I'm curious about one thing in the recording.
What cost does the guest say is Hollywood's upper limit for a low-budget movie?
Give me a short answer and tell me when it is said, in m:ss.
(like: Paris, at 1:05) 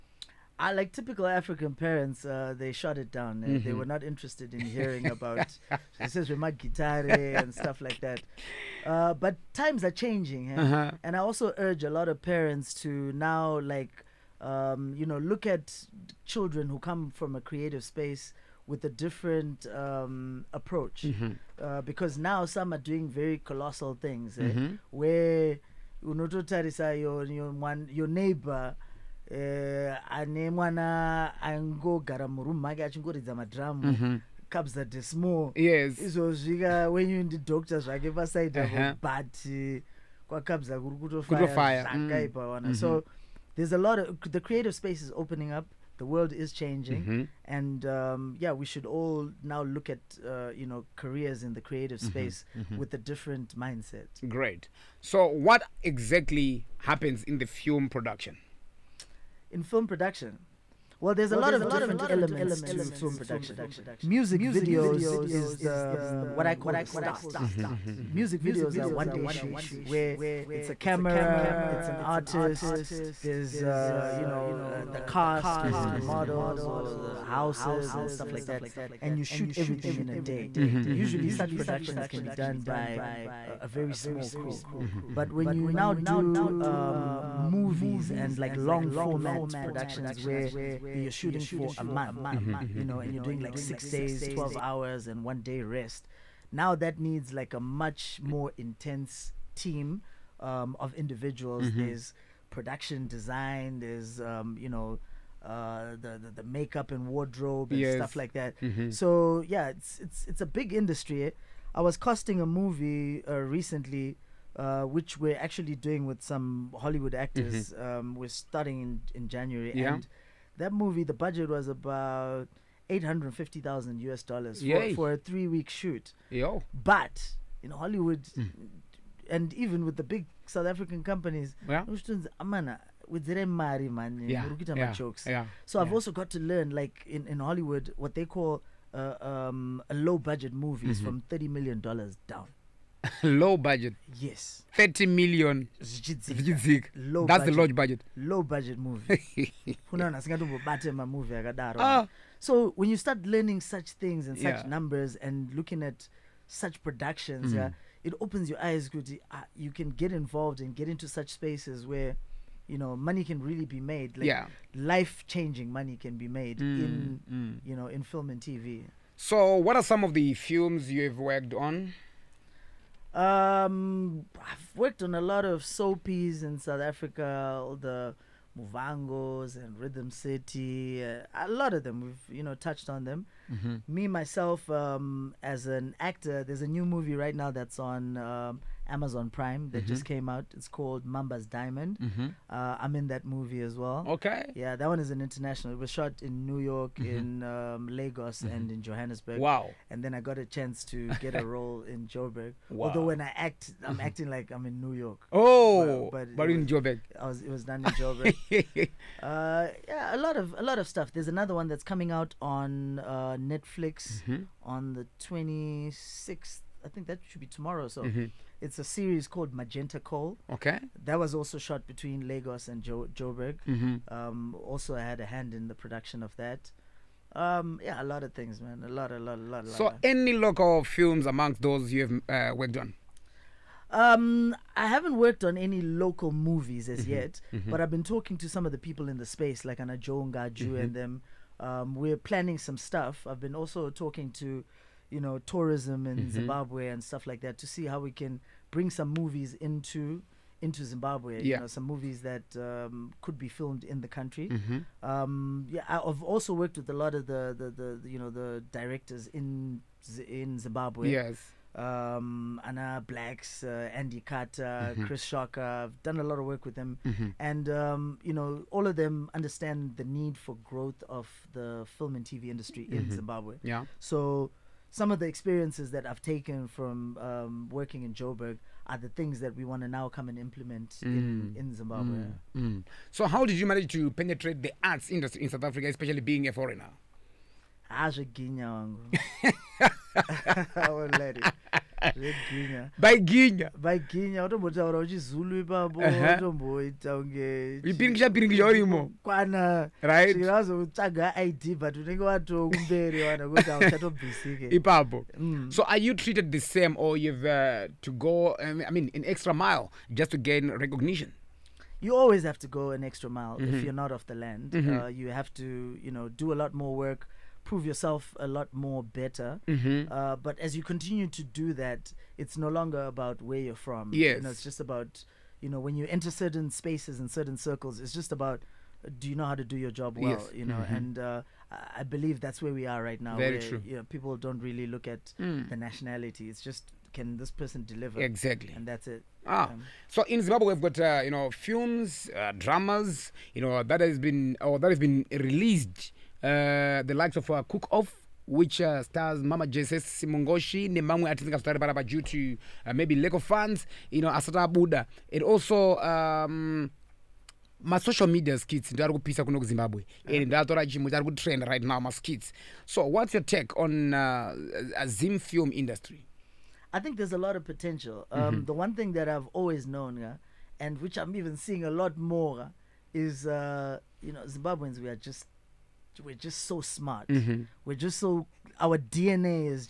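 $30 million, at 2:21.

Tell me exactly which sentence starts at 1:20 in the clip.
usually such productions can be done by a, very small crew mm-hmm.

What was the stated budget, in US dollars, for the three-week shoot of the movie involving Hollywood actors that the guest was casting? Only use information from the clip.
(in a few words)
$850,000.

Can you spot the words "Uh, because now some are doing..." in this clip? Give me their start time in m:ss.
0:21.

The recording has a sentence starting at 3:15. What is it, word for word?
It was shot in New York, mm-hmm.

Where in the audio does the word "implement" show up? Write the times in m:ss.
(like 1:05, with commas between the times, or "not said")
4:40.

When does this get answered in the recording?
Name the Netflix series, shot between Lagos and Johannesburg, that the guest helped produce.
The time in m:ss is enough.
3:39.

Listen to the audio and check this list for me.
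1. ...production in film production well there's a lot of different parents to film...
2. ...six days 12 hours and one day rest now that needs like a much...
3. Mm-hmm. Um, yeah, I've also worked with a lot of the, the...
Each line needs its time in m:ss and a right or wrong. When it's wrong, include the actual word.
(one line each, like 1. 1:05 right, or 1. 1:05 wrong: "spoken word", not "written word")
1. 0:57 wrong: "elements", not "parents"
2. 1:33 right
3. 4:14 right.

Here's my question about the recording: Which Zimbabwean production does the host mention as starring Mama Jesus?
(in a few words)
Cook Off.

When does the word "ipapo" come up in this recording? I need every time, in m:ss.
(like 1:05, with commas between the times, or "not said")
4:55, 5:04.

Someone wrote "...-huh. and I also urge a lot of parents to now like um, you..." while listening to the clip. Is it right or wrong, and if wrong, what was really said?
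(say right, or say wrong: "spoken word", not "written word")
right.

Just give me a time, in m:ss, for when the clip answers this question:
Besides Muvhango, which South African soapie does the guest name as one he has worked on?
2:59.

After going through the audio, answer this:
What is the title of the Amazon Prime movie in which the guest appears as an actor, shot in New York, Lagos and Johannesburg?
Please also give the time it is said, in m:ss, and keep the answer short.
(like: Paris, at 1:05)
Mamba's Diamond, at 3:11.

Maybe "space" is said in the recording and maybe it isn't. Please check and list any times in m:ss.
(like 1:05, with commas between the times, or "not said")
0:17, 0:44, 0:52, 2:41, 3:59, 5:26.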